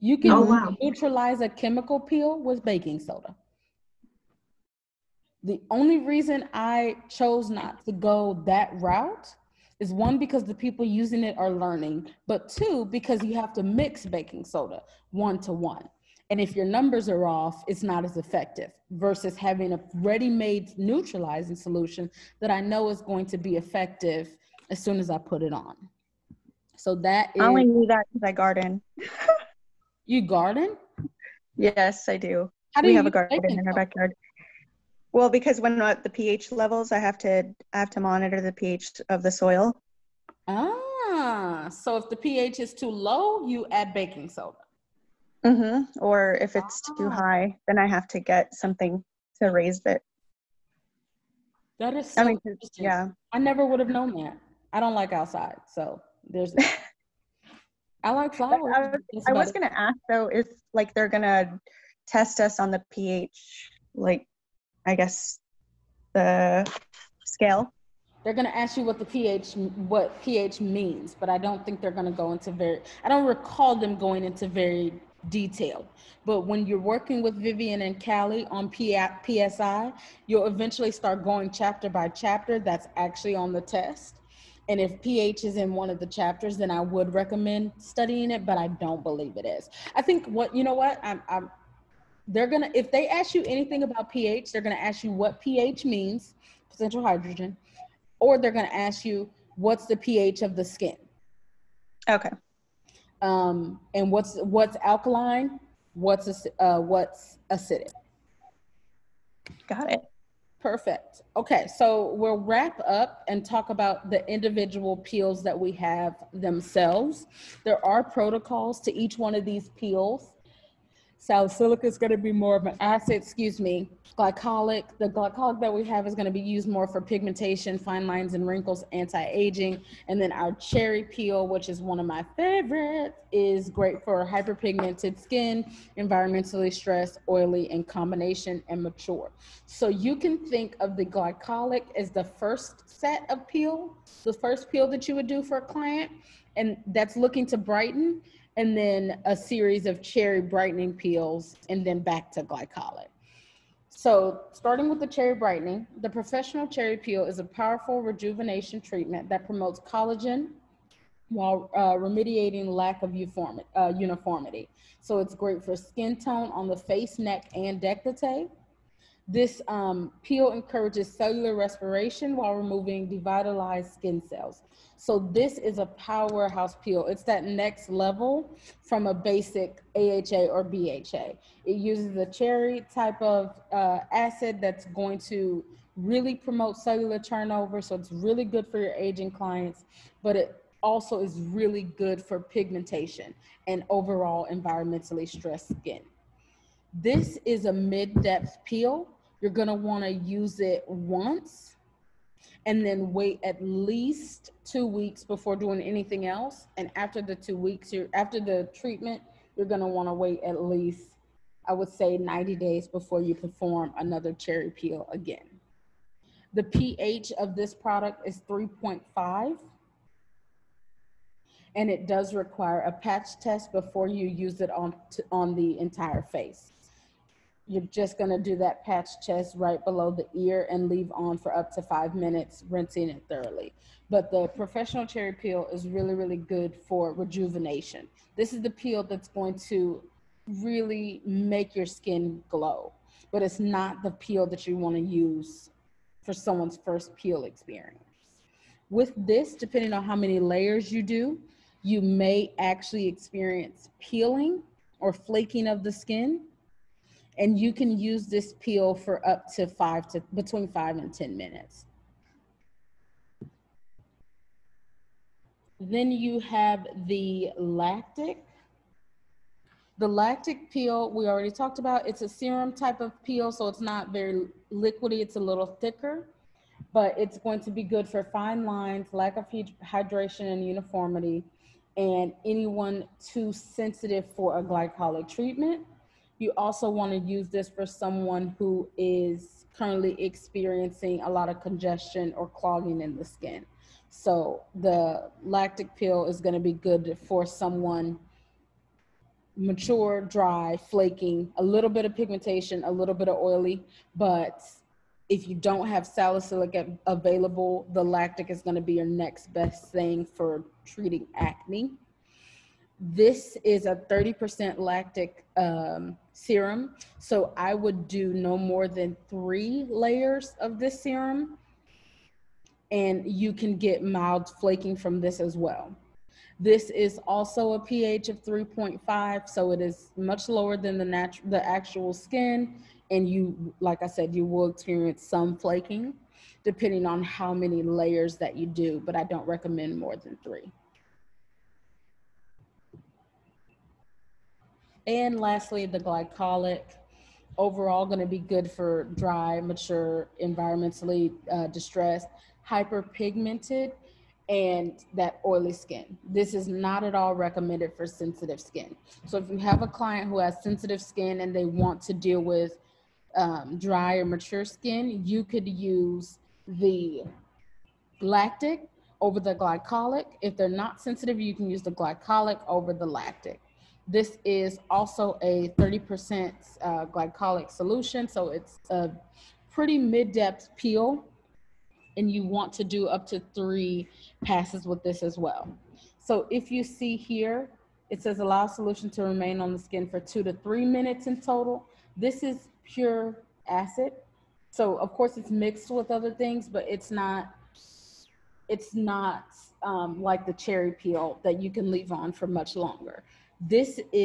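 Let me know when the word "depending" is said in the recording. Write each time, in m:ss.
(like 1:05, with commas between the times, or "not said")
4:09, 5:36.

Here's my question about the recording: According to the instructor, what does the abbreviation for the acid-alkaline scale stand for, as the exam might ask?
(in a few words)
potential hydrogen.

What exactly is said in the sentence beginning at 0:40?
Ah, so if the pH is too low, you add baking soda.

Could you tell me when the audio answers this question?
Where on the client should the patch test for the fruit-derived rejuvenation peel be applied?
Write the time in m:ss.
3:49.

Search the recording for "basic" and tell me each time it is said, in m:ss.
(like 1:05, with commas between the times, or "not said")
2:59.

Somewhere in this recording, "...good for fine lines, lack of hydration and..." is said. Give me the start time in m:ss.
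4:37.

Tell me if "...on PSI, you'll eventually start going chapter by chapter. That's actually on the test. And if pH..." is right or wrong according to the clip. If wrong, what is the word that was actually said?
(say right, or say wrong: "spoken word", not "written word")
right.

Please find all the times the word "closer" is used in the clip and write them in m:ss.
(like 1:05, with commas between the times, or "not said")
not said.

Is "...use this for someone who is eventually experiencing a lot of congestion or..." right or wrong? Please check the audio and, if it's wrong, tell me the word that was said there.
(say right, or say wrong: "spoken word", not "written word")
wrong: "currently", not "eventually".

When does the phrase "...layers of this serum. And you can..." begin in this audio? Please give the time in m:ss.
5:19.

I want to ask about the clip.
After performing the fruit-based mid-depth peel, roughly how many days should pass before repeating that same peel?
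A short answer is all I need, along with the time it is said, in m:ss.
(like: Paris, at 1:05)
90 days, at 3:32.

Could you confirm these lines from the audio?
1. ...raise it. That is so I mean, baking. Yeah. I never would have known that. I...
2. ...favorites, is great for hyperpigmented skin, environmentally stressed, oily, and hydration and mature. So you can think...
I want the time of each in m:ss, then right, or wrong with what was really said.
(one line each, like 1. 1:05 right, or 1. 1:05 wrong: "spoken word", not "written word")
1. 0:49 wrong: "interesting", not "baking"
2. 2:12 wrong: "combination", not "hydration".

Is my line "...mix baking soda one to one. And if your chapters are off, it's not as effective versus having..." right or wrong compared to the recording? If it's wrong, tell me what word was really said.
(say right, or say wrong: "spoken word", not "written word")
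wrong: "numbers", not "chapters".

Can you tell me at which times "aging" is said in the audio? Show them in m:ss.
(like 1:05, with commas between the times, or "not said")
2:08, 3:08.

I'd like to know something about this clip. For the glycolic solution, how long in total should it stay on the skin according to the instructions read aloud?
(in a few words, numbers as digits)
2 to 3 minutes.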